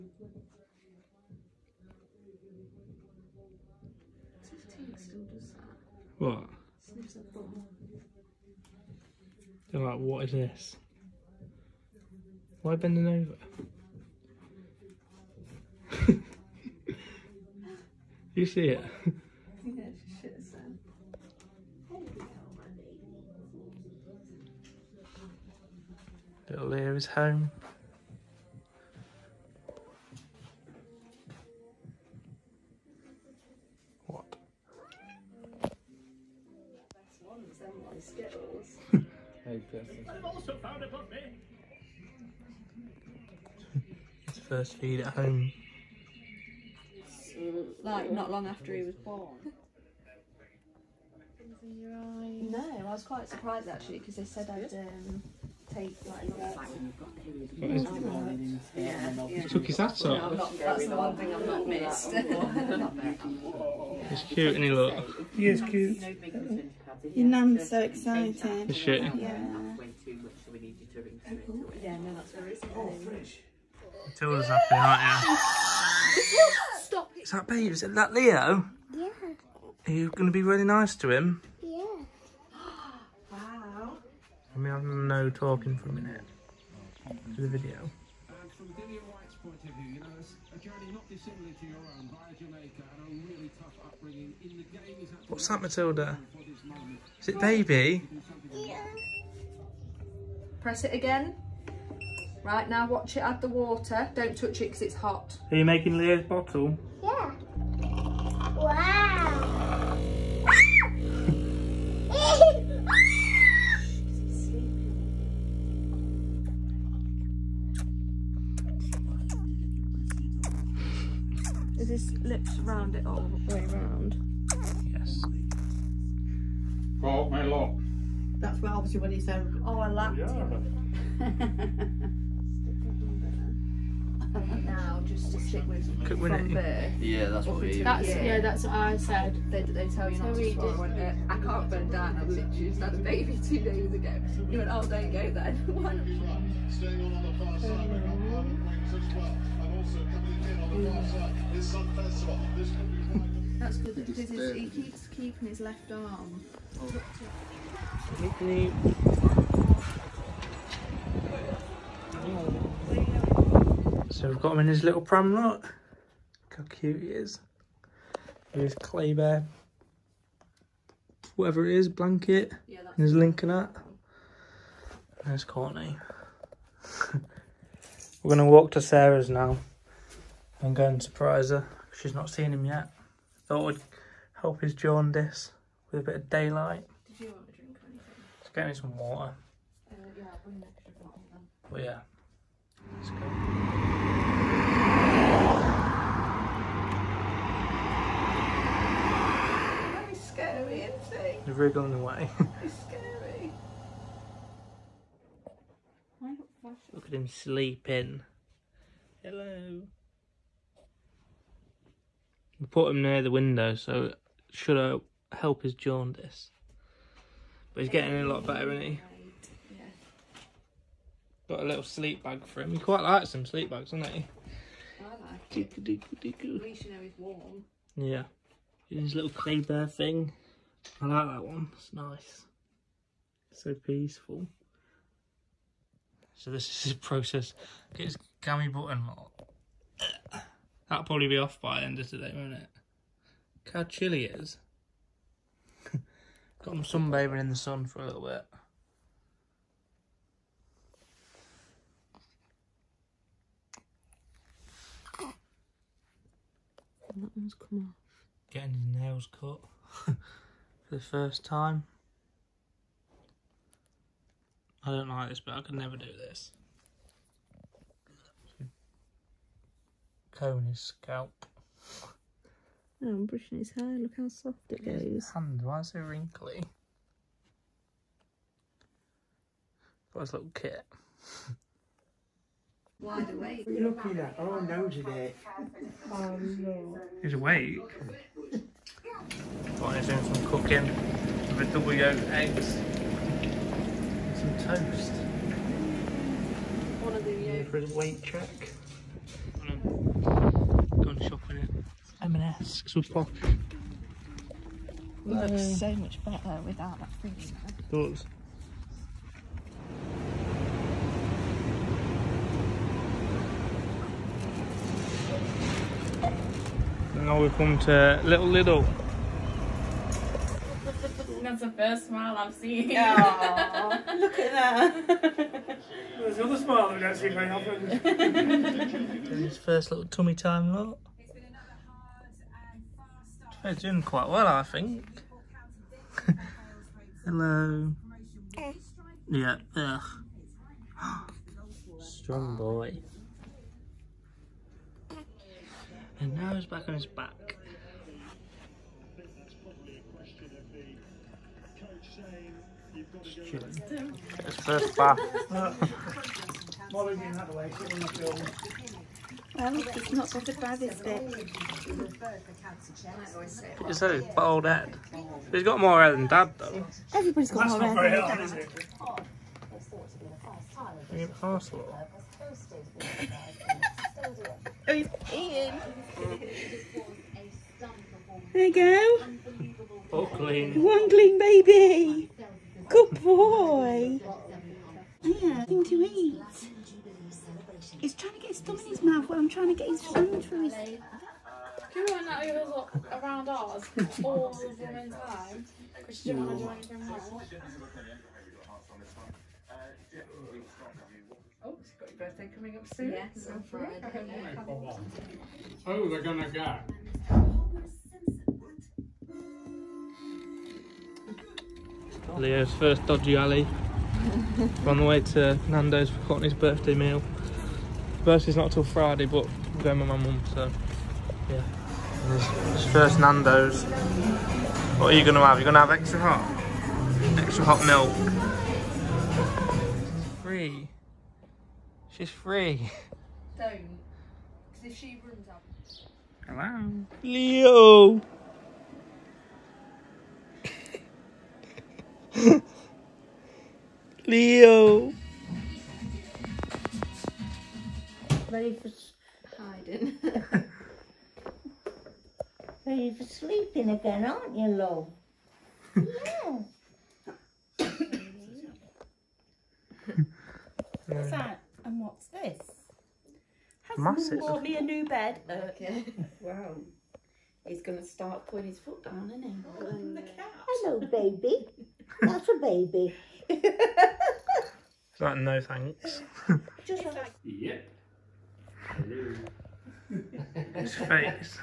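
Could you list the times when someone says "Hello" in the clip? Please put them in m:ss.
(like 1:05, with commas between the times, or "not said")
3:29, 5:37, 7:16, 7:50.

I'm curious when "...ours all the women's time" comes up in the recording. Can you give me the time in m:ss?
6:33.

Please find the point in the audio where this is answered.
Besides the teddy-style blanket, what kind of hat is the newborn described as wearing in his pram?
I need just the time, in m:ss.
2:53.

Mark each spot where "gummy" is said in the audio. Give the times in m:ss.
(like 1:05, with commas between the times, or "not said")
3:58.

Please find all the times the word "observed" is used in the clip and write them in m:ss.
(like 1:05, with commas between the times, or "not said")
not said.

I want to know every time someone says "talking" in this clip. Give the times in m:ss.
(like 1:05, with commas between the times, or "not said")
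1:25.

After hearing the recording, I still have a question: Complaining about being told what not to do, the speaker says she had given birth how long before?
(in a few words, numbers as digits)
2 days ago.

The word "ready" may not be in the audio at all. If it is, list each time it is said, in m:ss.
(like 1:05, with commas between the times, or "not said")
7:28, 7:32.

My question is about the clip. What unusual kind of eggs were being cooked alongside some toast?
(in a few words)
Double yolk eggs.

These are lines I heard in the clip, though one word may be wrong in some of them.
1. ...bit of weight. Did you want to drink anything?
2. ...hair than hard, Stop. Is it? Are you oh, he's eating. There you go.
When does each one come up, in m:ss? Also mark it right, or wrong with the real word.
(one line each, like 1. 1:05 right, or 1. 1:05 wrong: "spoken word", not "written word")
1. 3:06 wrong: "daylight", not "weight"
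2. 6:07 wrong: "Dad", not "Stop".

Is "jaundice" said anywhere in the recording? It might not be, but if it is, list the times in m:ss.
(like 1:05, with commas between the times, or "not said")
3:04, 3:35.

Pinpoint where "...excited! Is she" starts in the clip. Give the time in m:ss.
1:07.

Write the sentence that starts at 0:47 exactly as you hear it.
Like, not long after he was born.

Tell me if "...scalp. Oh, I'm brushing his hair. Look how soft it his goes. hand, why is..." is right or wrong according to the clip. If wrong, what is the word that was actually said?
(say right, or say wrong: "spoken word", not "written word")
right.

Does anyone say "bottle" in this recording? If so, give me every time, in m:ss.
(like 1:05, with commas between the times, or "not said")
1:46, 3:10.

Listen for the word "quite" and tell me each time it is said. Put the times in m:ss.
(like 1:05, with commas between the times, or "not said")
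0:53, 3:42, 5:34.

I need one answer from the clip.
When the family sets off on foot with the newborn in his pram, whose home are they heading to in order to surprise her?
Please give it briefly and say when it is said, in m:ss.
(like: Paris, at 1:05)
Sarah's, at 2:58.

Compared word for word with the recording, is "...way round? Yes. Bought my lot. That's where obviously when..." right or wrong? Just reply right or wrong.
right.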